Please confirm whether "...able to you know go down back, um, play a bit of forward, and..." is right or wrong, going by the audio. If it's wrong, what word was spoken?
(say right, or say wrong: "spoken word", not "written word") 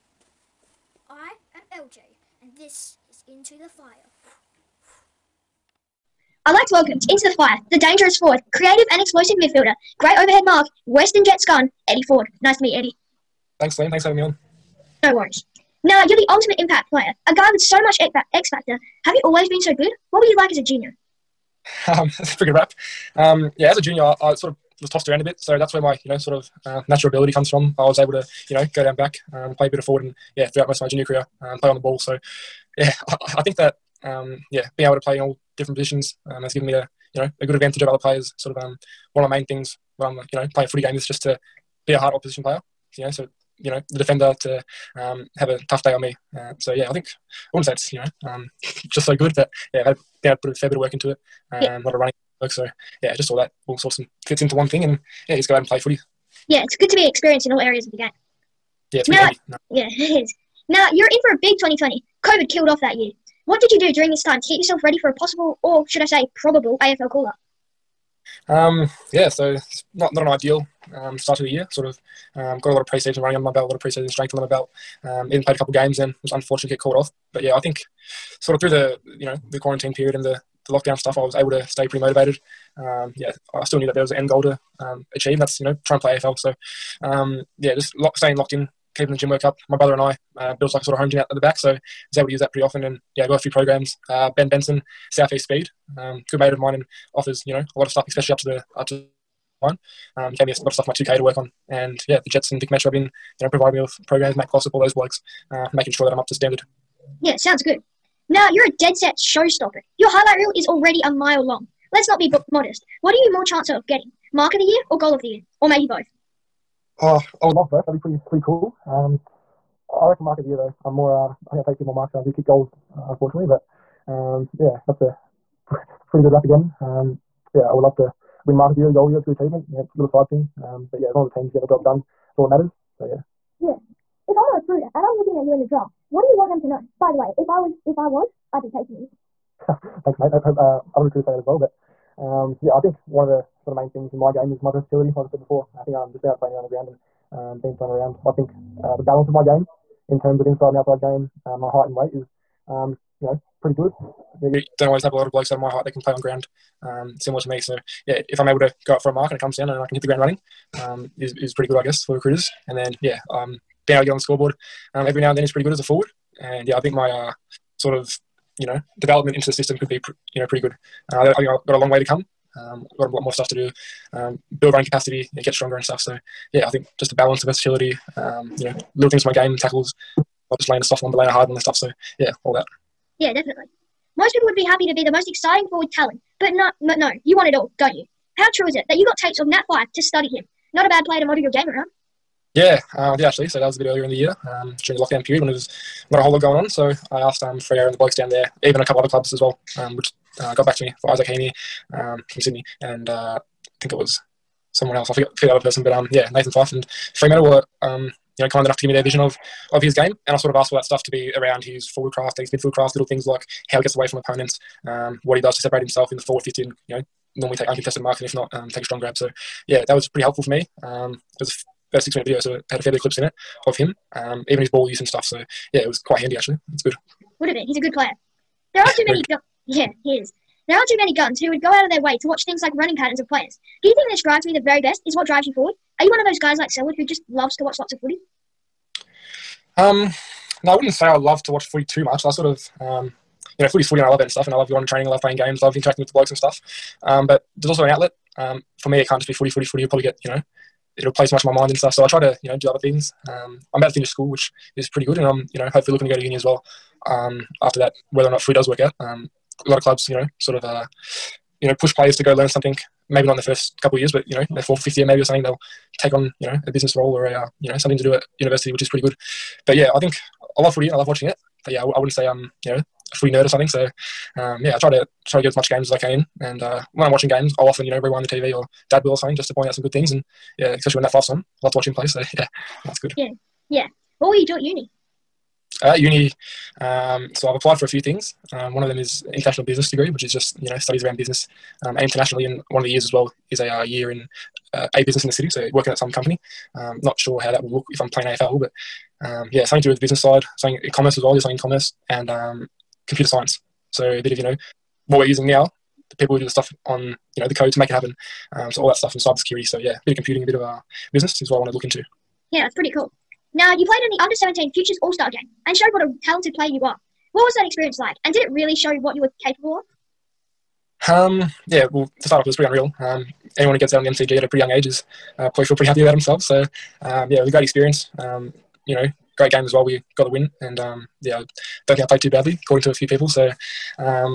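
right.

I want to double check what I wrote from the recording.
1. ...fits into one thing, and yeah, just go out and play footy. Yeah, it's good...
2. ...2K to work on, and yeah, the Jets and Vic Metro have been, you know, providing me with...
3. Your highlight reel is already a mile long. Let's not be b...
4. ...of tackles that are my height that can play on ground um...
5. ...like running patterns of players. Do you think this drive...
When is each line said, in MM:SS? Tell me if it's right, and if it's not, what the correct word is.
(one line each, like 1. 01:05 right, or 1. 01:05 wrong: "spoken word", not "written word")
1. 00:54 right
2. 01:40 right
3. 01:49 right
4. 02:35 wrong: "blokes", not "tackles"
5. 03:52 right.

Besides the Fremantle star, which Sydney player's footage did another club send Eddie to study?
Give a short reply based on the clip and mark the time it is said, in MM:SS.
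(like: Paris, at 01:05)
Isaac Heeney, at 03:21.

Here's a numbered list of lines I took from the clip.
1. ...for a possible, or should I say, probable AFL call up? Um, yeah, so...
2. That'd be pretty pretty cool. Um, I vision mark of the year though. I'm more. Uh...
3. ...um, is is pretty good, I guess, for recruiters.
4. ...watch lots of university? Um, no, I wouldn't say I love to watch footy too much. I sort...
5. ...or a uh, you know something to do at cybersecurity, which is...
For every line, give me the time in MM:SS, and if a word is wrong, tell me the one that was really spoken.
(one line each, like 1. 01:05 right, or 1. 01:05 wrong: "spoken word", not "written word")
1. 01:04 right
2. 01:57 wrong: "reckon", not "vision"
3. 02:40 right
4. 03:57 wrong: "footy", not "university"
5. 04:27 wrong: "university", not "cybersecurity".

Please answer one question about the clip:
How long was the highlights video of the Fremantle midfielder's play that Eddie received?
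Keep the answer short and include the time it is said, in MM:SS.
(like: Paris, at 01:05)
6 minutes, at 03:41.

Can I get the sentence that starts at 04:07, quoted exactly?
Um, but there's also an outlet um, for me, it can't just be footy, footy, footy.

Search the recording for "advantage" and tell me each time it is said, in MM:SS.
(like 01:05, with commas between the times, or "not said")
00:37.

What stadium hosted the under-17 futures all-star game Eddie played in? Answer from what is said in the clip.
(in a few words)
MCG.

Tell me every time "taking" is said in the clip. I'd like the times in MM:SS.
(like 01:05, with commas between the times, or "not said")
02:18.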